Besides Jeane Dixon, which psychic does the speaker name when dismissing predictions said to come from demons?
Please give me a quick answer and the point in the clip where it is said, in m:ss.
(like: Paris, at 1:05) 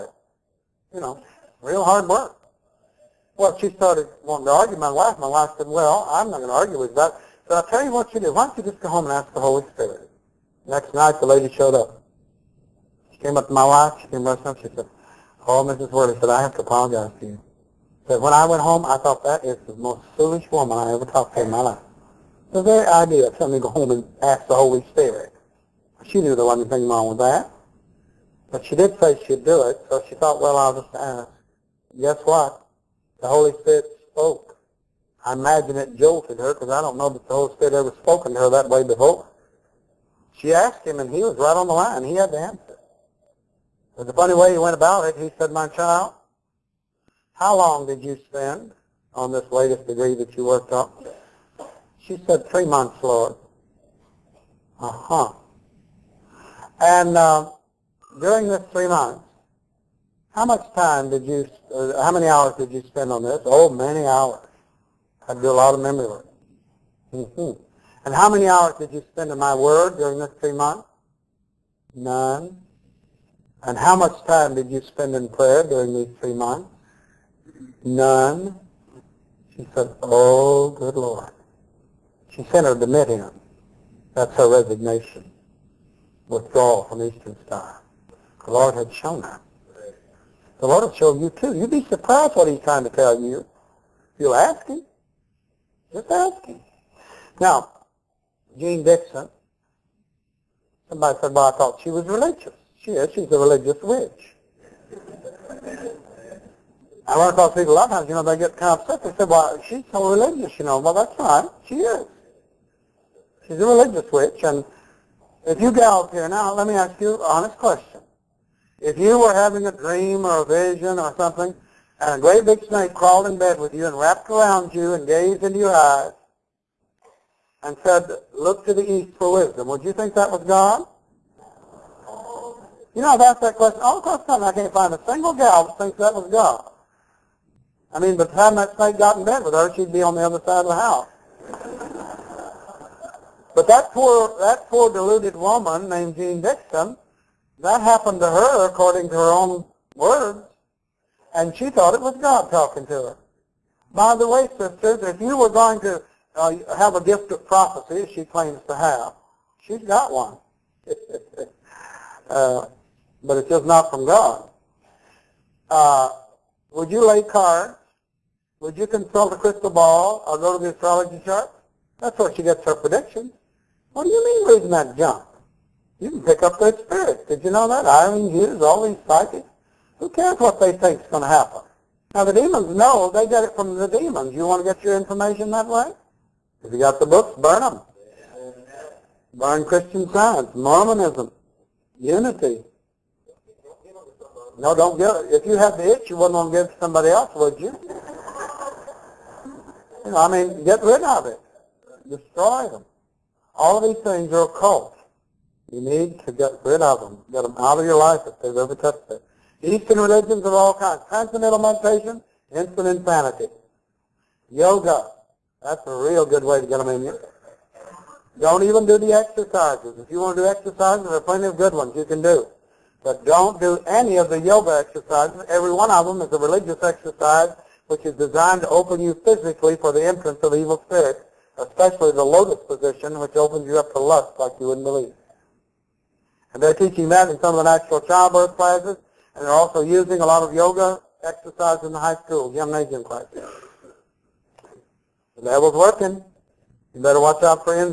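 Irene Hughes, at 2:57.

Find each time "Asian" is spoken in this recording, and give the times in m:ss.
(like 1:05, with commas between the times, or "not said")
4:02.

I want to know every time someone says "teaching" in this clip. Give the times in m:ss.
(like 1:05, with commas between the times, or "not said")
3:56.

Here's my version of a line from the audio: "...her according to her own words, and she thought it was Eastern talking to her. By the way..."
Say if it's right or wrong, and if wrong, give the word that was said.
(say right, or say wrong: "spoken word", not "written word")
wrong: "God", not "Eastern".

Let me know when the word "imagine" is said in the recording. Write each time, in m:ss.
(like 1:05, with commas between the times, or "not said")
0:35.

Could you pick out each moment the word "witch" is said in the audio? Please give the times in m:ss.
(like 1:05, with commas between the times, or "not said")
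1:43, 1:54.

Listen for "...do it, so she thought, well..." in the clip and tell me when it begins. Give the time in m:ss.
0:29.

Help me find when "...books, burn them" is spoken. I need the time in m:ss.
3:07.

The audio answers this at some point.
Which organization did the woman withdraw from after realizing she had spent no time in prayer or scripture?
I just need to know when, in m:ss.
1:27.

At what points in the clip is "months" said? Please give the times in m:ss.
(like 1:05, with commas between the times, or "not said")
0:52, 0:58, 1:10, 1:16.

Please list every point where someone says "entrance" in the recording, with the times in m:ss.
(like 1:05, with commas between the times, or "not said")
3:50.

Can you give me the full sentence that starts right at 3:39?
If you want to do exercises, there are plenty of good ones you can do.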